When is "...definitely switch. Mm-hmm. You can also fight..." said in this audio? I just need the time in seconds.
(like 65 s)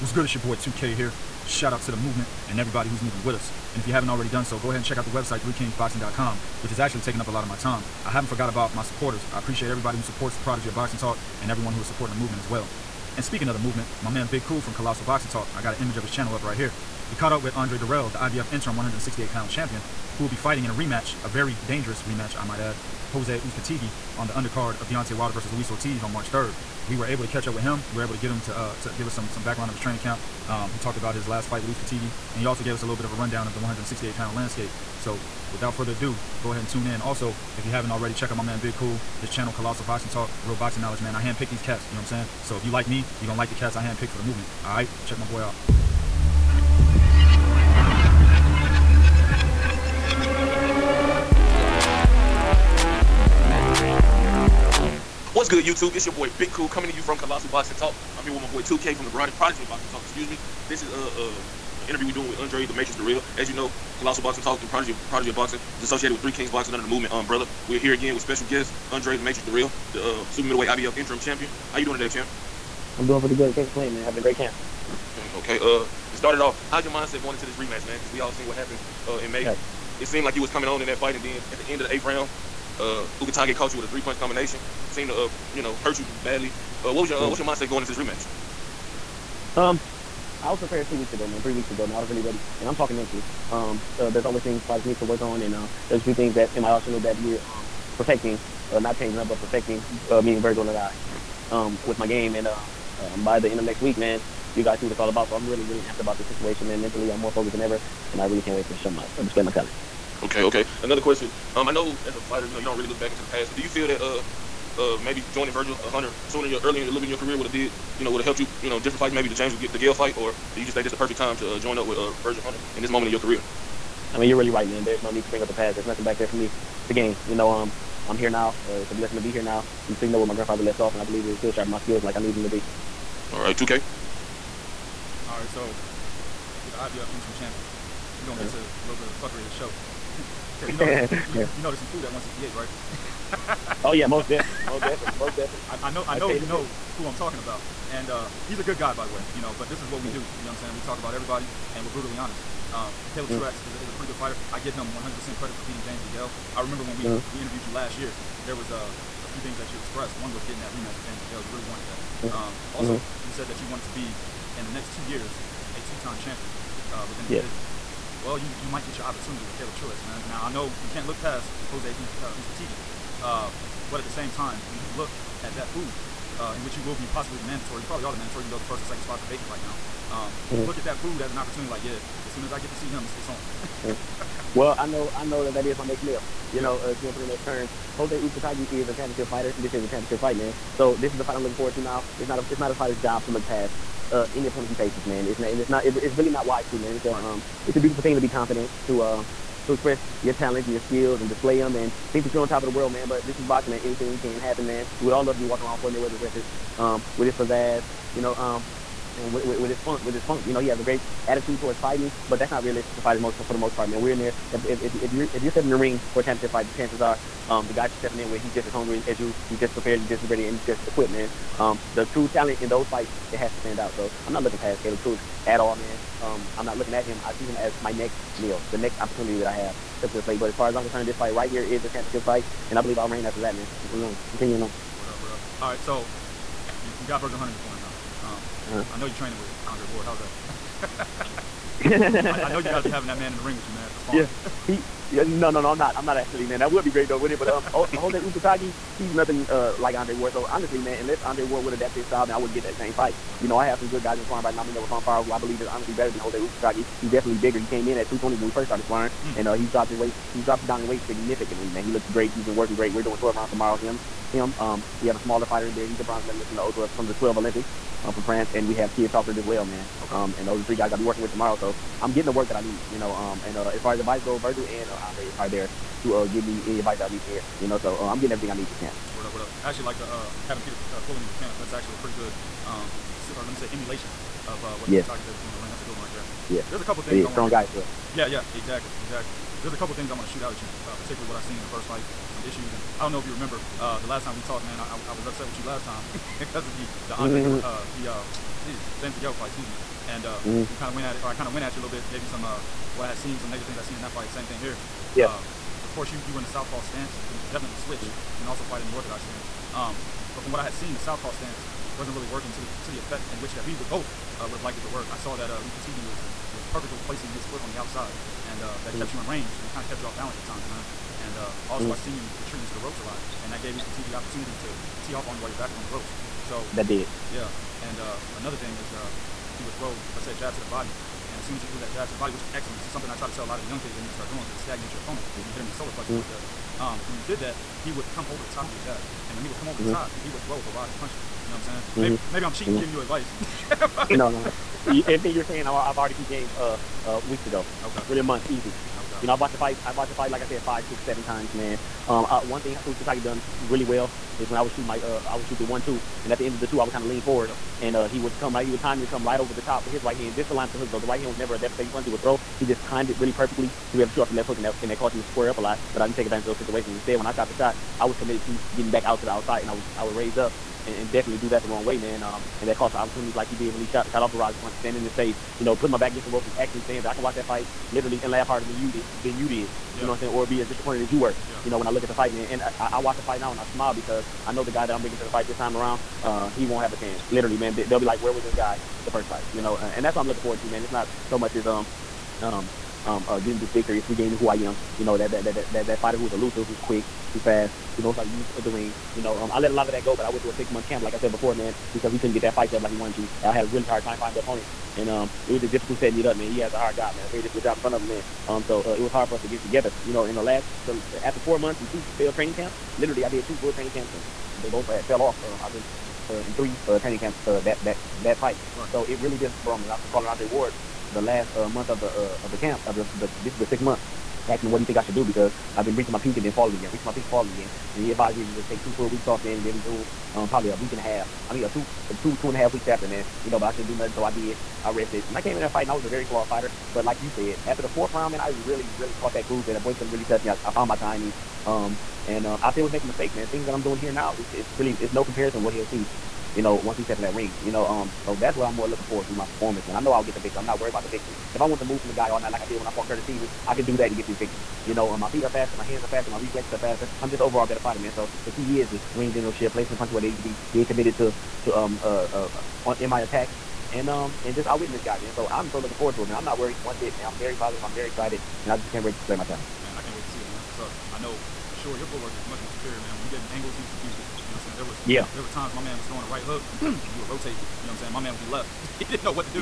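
307 s.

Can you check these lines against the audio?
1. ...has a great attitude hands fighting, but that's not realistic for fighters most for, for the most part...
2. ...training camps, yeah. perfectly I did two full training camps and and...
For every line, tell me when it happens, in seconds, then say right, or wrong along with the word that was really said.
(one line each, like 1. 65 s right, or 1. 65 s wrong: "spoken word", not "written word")
1. 210 s wrong: "towards", not "hands"
2. 412 s wrong: "literally", not "perfectly".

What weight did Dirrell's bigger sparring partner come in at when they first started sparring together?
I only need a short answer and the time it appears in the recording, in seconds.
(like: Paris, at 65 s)
220, at 258 s.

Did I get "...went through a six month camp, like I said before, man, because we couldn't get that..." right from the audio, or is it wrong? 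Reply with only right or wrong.
right.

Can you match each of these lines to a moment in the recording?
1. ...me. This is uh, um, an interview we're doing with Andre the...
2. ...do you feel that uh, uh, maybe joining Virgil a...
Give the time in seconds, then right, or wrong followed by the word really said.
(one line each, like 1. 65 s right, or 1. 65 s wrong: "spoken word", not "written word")
1. 60 s right
2. 113 s right.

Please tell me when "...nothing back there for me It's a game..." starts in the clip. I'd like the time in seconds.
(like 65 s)
125 s.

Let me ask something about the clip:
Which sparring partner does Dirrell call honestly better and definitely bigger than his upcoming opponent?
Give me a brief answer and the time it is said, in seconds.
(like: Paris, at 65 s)
Fonfara, at 254 s.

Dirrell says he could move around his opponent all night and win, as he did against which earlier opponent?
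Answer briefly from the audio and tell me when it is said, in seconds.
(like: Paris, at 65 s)
Curtis Stevens, at 453 s.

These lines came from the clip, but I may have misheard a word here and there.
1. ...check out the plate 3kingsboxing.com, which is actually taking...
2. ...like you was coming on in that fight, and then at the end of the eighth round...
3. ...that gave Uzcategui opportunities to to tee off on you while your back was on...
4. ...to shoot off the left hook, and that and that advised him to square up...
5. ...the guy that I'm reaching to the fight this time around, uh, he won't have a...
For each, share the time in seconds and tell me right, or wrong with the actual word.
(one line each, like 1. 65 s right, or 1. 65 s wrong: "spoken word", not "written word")
1. 4 s wrong: "website", not "plate"
2. 80 s right
3. 323 s right
4. 364 s wrong: "caused", not "advised"
5. 384 s wrong: "bringing", not "reaching".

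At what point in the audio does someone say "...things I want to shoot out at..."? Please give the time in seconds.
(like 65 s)
289 s.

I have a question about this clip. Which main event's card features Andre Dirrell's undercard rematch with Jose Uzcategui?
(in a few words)
Deontay Wilder versus Luis Ortiz.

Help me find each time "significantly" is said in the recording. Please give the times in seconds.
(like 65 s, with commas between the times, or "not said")
261 s.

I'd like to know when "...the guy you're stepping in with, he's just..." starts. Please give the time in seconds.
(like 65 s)
217 s.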